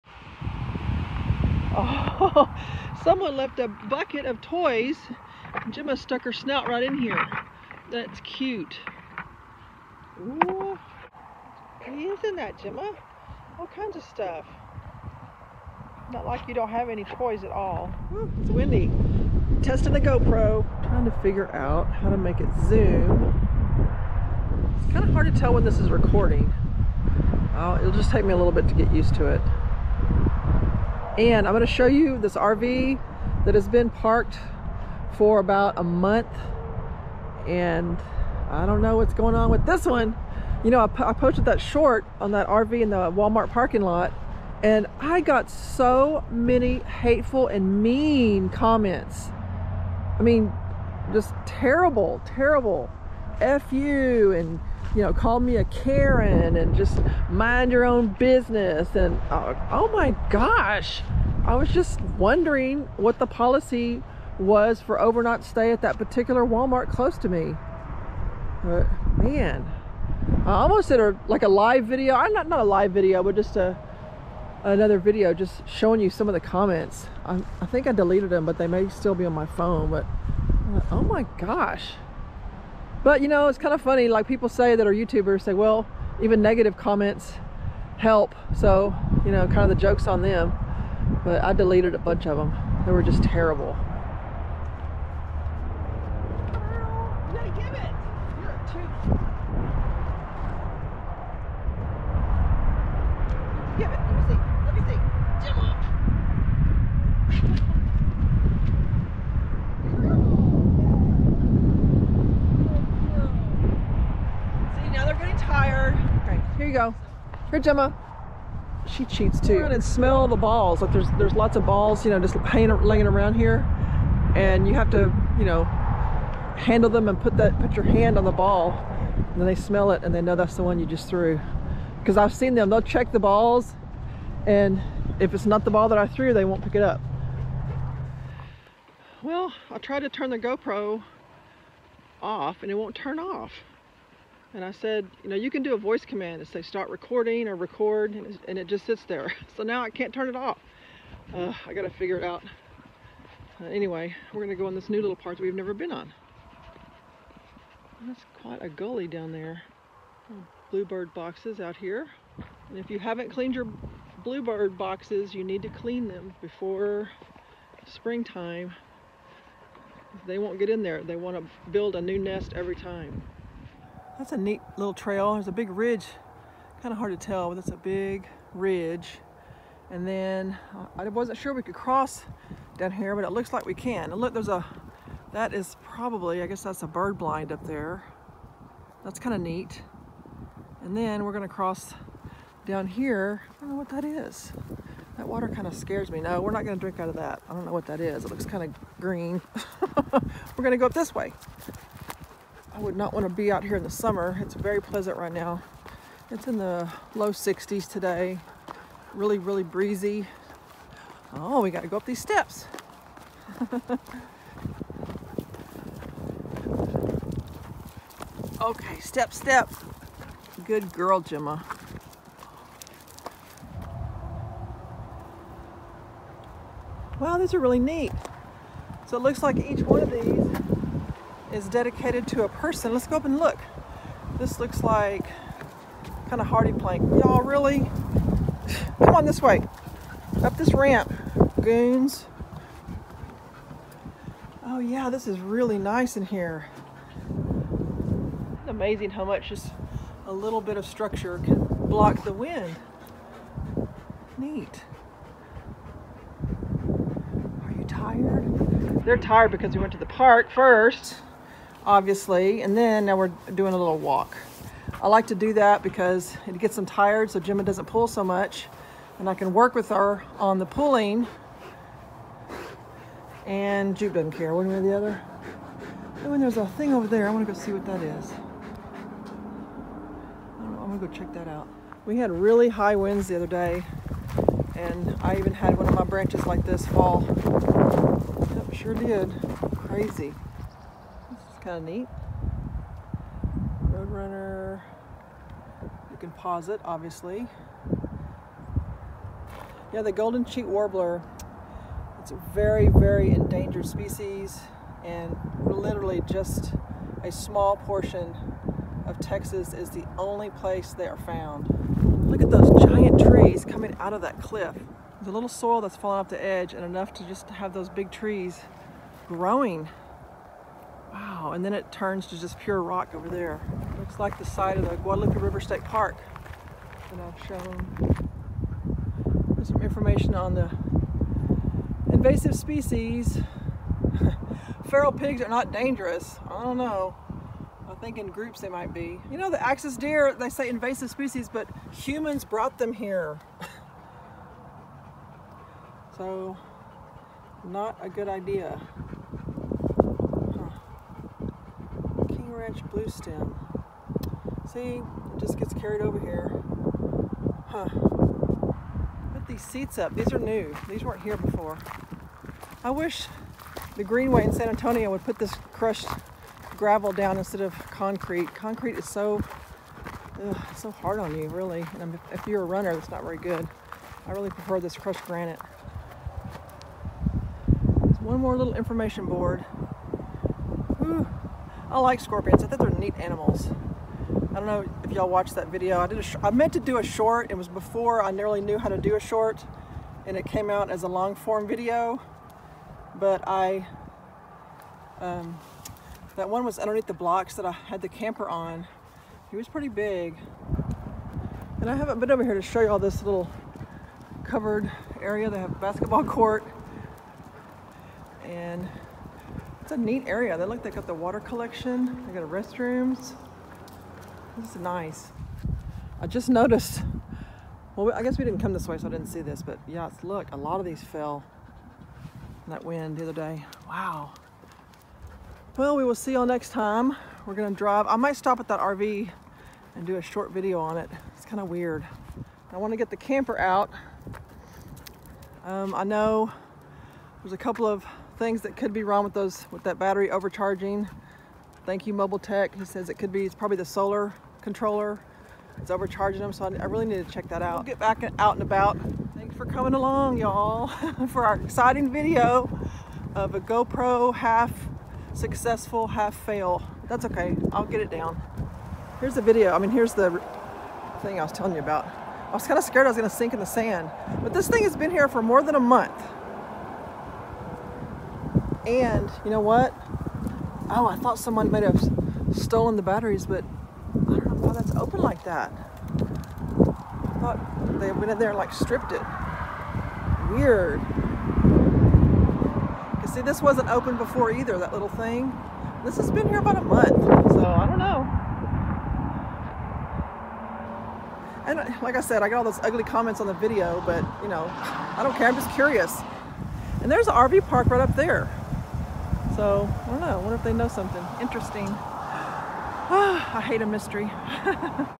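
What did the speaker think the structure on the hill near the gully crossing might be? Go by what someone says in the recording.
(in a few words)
A bird blind.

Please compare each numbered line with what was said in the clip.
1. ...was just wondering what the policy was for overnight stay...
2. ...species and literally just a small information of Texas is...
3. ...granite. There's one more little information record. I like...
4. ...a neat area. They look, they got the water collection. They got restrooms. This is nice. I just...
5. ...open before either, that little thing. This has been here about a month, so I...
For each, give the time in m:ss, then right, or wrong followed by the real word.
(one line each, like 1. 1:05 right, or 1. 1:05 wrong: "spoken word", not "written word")
1. 1:01 right
2. 5:03 wrong: "portion", not "information"
3. 6:15 wrong: "board", not "record"
4. 6:49 right
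5. 8:03 right.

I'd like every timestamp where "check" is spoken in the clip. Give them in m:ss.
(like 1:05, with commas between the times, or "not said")
2:12, 4:41, 7:27.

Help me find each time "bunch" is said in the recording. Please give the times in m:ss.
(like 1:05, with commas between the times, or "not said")
1:31.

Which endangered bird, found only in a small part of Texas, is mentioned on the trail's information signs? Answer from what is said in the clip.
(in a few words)
Golden cheek warbler.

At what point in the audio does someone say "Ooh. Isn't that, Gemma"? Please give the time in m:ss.
0:10.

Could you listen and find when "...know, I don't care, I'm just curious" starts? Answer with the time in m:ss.
8:14.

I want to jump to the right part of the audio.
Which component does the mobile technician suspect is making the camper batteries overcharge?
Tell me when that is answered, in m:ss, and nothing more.
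7:23.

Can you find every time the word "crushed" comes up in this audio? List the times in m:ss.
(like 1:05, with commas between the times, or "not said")
6:05, 6:14.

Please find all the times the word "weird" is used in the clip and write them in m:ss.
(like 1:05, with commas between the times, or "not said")
7:11, 8:00.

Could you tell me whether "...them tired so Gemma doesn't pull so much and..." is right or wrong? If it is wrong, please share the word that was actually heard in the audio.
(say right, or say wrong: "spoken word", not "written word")
right.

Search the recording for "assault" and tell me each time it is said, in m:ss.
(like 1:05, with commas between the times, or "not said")
not said.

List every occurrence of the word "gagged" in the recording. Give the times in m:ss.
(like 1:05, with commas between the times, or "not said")
not said.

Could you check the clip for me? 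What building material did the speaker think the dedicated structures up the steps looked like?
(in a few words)
HardiePlank.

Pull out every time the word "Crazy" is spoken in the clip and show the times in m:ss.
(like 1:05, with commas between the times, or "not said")
4:49.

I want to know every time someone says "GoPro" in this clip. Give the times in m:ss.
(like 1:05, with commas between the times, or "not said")
0:20, 2:20, 7:33.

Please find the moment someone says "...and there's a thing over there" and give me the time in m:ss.
4:36.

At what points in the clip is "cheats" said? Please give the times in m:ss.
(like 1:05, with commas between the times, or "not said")
1:59.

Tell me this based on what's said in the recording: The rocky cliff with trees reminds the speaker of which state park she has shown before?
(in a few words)
Guadalupe River State Park.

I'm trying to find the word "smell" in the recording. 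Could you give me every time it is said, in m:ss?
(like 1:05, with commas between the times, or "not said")
1:59, 2:09.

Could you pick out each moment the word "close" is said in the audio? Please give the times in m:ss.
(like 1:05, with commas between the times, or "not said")
1:06.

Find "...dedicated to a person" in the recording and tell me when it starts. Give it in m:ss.
3:51.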